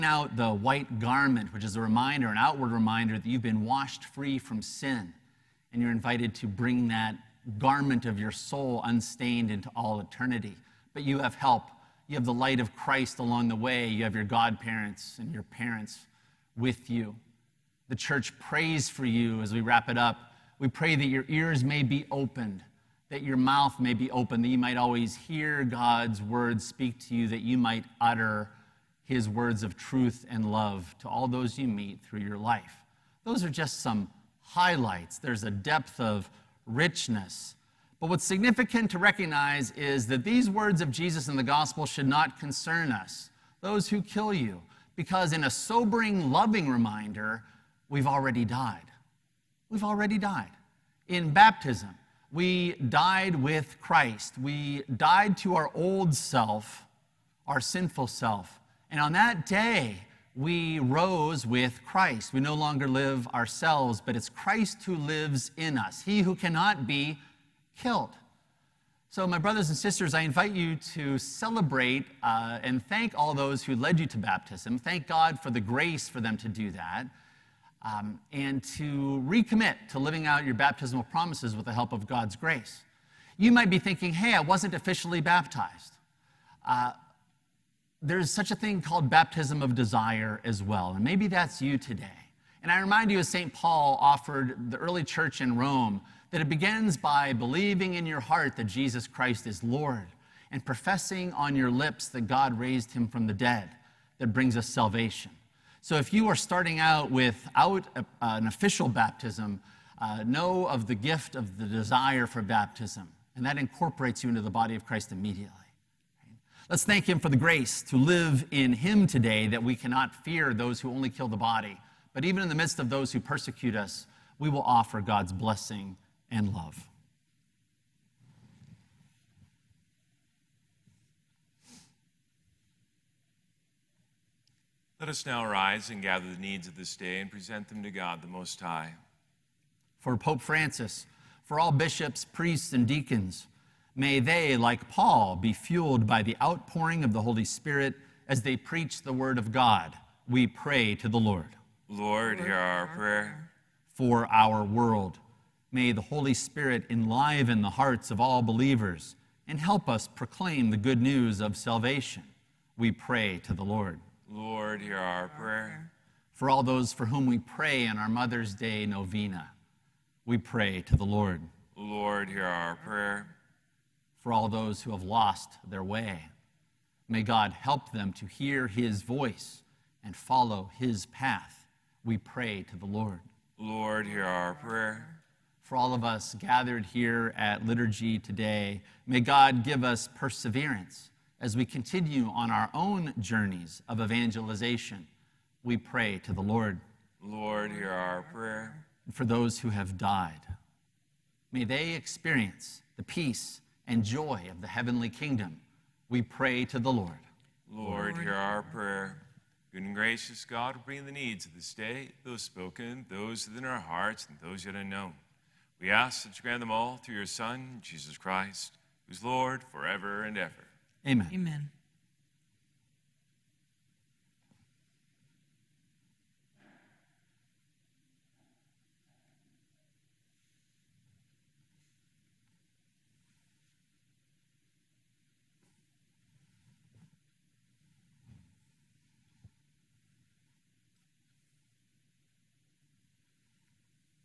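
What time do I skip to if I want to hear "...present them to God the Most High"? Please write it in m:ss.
2:17.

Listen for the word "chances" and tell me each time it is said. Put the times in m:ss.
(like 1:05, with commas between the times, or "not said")
not said.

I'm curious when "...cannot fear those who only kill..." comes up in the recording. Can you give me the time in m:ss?
1:59.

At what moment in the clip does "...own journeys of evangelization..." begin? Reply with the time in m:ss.
3:12.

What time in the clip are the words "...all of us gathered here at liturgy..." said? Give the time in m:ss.
3:05.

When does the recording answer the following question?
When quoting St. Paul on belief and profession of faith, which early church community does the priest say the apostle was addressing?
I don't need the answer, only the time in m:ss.
1:35.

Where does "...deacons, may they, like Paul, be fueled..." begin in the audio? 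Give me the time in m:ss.
2:22.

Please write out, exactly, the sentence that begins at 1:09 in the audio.
So, my brothers and sisters, I invite you to celebrate uh, and thank all those who led you to baptism.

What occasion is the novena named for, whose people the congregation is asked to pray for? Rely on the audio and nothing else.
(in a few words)
Mother's Day.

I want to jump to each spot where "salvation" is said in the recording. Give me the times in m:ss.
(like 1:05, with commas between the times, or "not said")
1:44, 2:41.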